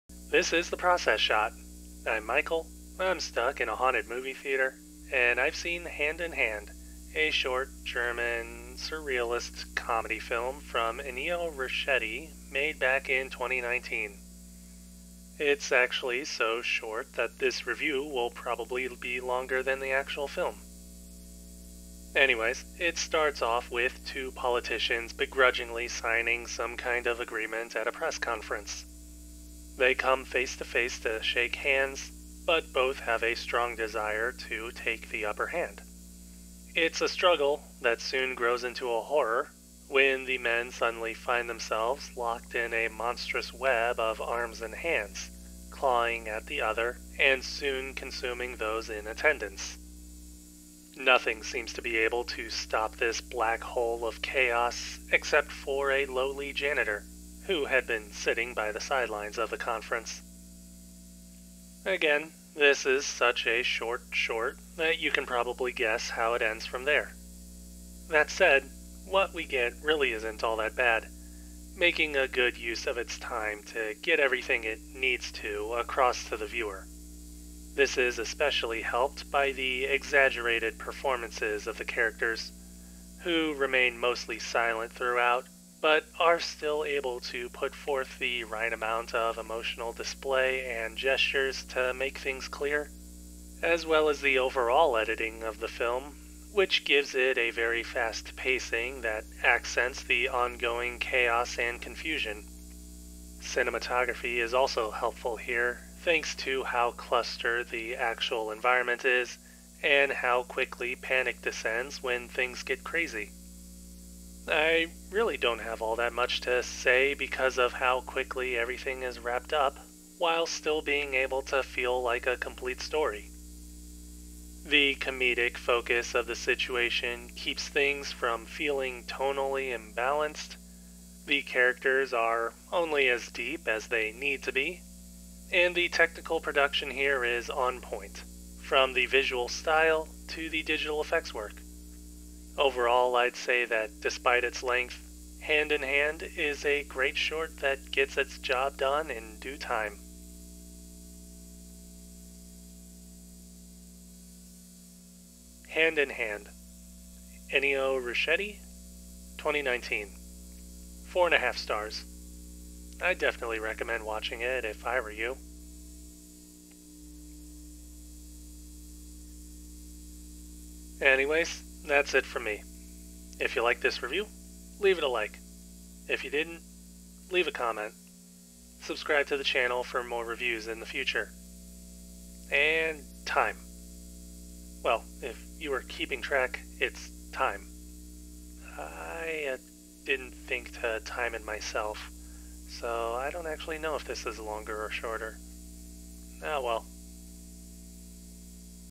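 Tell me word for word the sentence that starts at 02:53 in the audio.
If you like this review, leave it a like.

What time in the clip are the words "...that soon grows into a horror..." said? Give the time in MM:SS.
00:37.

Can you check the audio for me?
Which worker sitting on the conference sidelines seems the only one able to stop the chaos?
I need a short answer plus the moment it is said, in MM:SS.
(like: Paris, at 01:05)
Janitor, at 00:56.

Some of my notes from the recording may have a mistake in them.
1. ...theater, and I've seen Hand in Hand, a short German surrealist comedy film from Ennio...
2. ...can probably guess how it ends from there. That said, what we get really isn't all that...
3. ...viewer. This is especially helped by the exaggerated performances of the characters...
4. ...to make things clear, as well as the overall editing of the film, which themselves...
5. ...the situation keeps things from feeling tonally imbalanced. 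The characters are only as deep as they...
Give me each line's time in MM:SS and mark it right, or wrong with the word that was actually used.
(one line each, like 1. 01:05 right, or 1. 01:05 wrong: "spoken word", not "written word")
1. 00:04 right
2. 01:05 right
3. 01:16 right
4. 01:31 wrong: "gives", not "themselves"
5. 02:06 right.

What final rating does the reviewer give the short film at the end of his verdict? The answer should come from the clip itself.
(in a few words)
4.5 stars.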